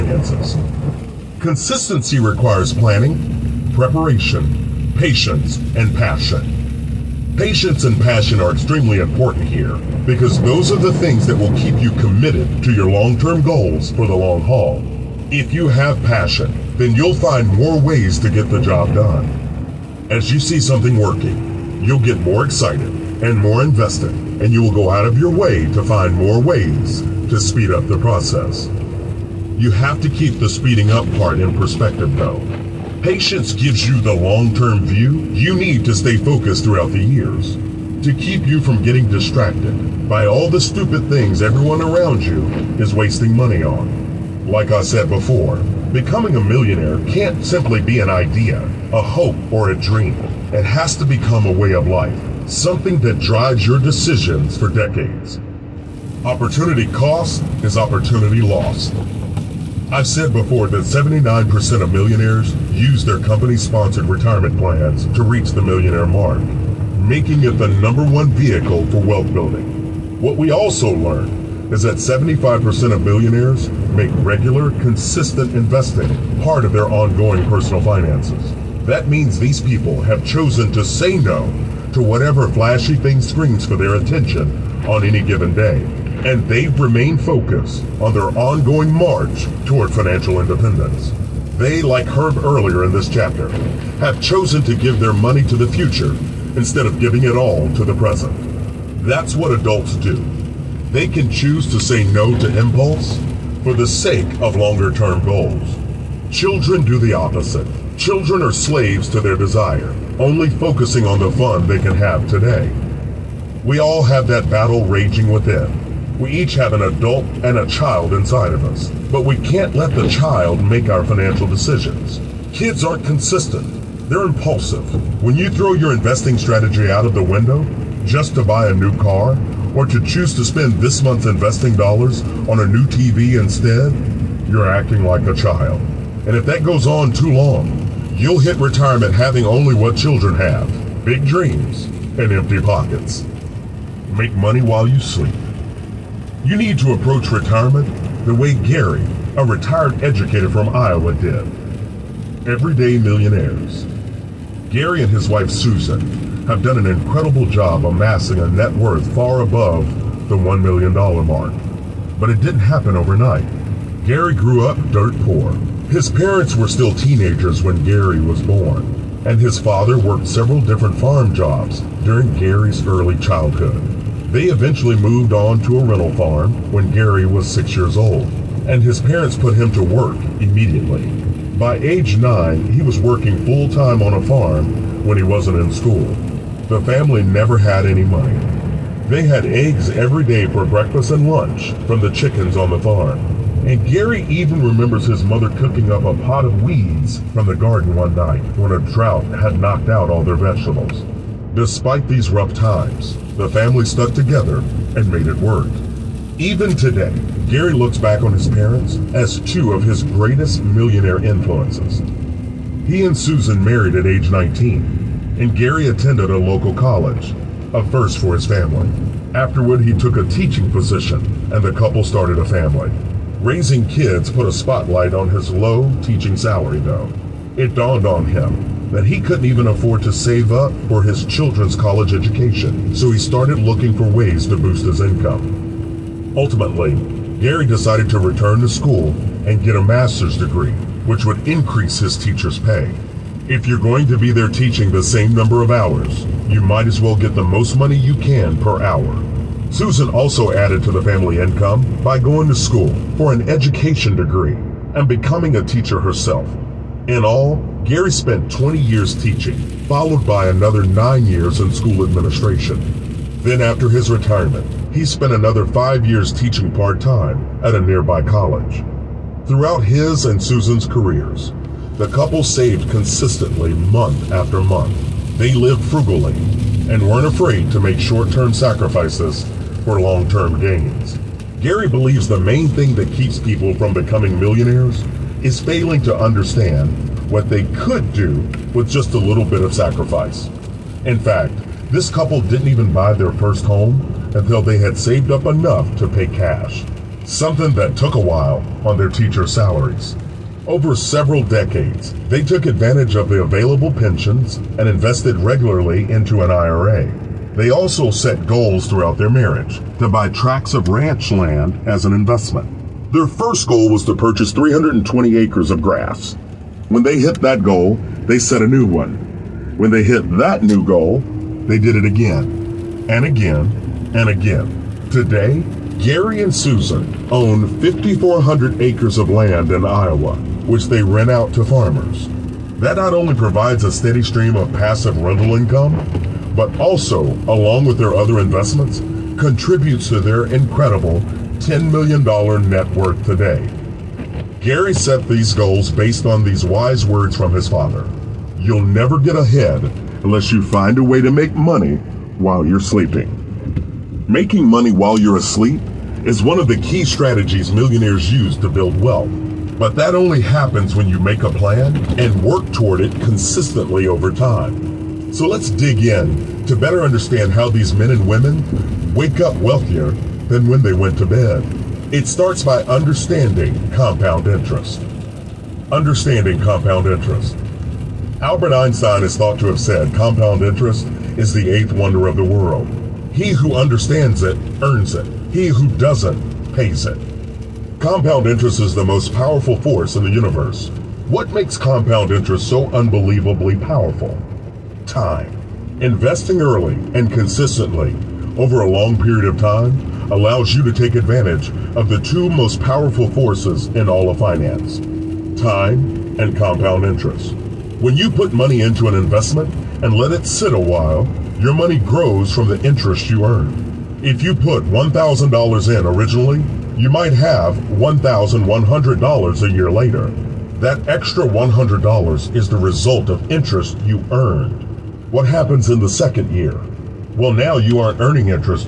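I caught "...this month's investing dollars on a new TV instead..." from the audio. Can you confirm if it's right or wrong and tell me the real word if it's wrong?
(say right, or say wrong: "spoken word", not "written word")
right.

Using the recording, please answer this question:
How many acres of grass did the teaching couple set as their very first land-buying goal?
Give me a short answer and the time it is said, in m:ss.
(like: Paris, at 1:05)
320, at 5:14.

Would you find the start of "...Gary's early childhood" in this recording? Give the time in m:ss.
2:52.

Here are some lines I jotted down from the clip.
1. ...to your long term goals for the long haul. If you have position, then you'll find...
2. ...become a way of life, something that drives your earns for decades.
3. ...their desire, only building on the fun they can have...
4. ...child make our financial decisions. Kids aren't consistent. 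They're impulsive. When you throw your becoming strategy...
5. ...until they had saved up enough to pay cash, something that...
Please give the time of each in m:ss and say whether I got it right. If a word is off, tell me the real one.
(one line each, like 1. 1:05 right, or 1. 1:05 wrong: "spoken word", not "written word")
1. 0:12 wrong: "passion", not "position"
2. 0:51 wrong: "decisions", not "earns"
3. 1:49 wrong: "focusing", not "building"
4. 2:00 wrong: "investing", not "becoming"
5. 4:54 right.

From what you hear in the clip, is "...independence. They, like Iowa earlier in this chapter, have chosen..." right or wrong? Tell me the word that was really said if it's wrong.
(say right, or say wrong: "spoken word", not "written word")
wrong: "Herb", not "Iowa".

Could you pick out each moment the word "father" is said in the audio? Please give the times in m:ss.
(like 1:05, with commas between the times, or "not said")
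2:49, 5:47.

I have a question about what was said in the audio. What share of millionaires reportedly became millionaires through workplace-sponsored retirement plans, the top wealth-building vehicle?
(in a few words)
79%.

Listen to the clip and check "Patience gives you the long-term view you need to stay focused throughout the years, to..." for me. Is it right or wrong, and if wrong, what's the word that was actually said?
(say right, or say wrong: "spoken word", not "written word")
right.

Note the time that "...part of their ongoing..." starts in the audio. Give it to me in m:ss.
1:16.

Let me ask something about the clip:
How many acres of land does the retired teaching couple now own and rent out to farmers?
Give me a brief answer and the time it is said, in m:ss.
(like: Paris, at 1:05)
5,400, at 5:27.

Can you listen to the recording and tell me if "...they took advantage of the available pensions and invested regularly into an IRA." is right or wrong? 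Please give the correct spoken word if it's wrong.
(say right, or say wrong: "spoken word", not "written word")
right.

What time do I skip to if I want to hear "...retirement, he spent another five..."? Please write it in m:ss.
4:24.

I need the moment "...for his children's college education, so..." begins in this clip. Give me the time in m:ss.
3:50.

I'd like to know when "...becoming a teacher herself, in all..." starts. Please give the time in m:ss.
4:15.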